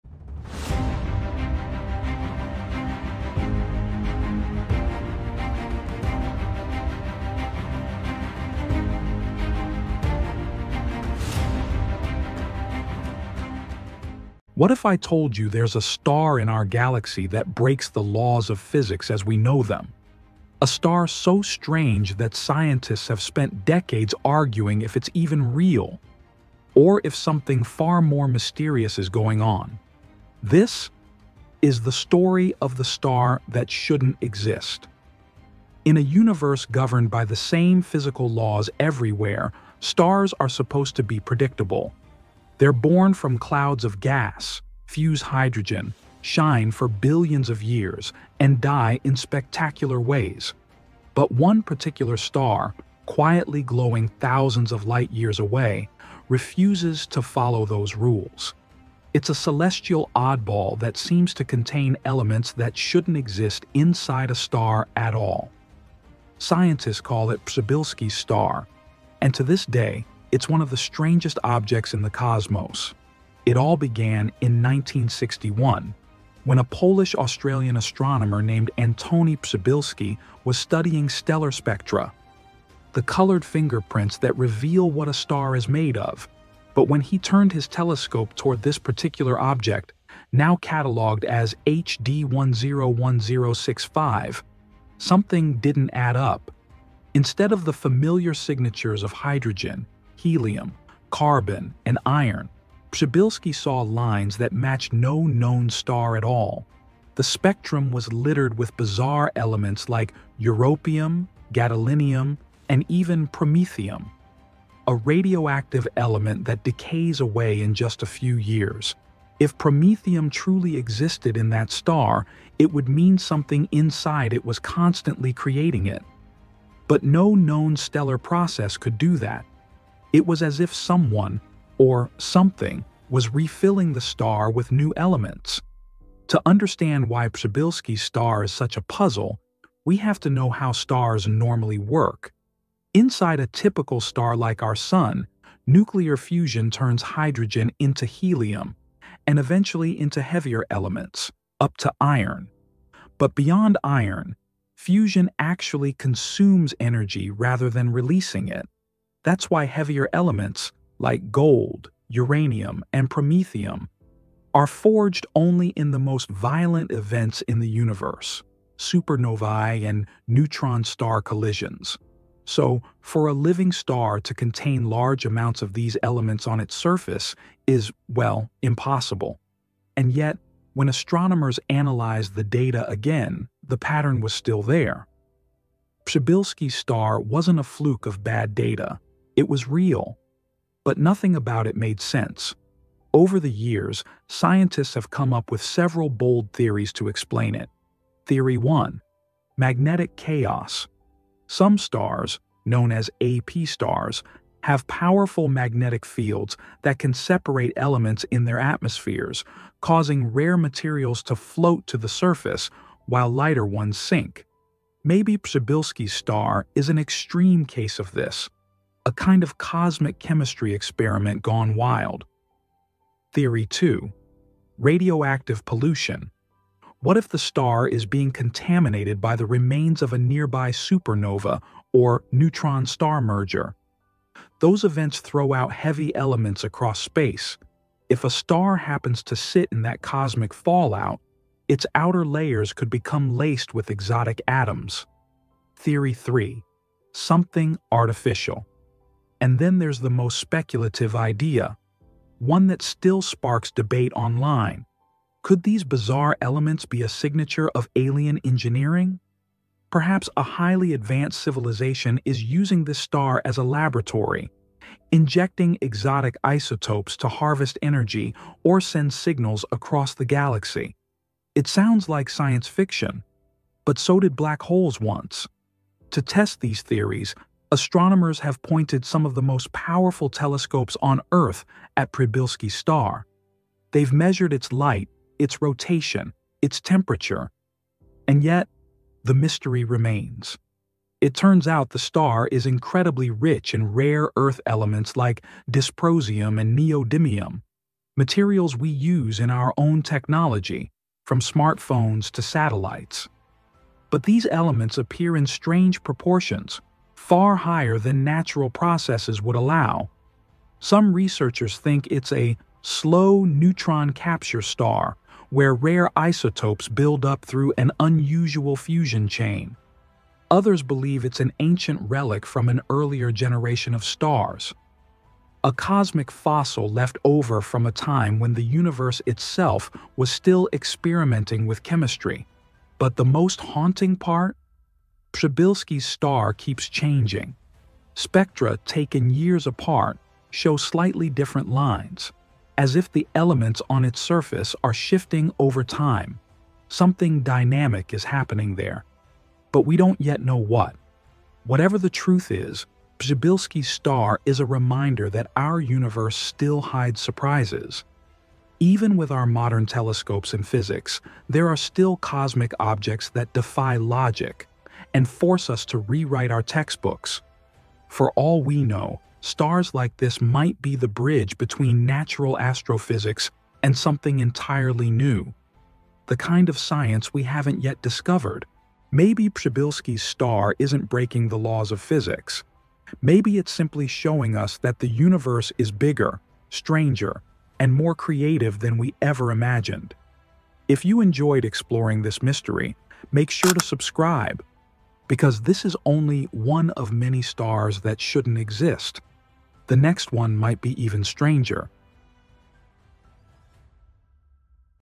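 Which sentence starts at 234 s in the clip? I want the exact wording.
Those events throw out heavy elements across space.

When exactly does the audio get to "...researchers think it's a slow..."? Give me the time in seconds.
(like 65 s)
311 s.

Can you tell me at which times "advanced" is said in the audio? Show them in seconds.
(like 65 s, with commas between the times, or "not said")
260 s.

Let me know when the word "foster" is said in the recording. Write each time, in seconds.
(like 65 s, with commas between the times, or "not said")
not said.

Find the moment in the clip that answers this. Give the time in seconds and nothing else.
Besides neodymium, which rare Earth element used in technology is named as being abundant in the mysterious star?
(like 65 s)
295 s.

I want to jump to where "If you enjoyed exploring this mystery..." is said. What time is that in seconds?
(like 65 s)
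390 s.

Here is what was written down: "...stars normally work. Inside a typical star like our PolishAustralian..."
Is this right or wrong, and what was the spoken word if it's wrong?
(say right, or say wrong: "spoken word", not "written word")
wrong: "Sun", not "PolishAustralian".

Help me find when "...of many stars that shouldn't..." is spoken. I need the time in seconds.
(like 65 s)
396 s.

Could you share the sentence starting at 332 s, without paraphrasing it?
But the most haunting part Przybylski's star keeps changing.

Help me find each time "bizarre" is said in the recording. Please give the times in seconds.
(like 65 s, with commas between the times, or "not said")
108 s, 255 s.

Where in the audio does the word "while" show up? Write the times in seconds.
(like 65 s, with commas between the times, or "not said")
213 s.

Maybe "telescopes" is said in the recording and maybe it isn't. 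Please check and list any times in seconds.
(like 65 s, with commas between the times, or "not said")
87 s, 280 s, 359 s.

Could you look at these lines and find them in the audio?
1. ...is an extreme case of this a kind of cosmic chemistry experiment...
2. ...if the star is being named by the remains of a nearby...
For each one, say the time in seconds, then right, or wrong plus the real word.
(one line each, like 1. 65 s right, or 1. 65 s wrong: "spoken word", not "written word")
1. 216 s right
2. 227 s wrong: "contaminated", not "named".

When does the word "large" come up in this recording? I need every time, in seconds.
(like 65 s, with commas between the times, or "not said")
174 s.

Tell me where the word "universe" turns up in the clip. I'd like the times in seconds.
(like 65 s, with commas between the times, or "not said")
36 s, 167 s, 328 s, 355 s, 385 s.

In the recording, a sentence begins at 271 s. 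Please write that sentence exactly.
It sounds like science fiction, but so did black holes once.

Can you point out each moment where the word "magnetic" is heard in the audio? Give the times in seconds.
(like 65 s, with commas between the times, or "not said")
199 s, 205 s.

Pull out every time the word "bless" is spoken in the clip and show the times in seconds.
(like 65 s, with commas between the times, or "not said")
not said.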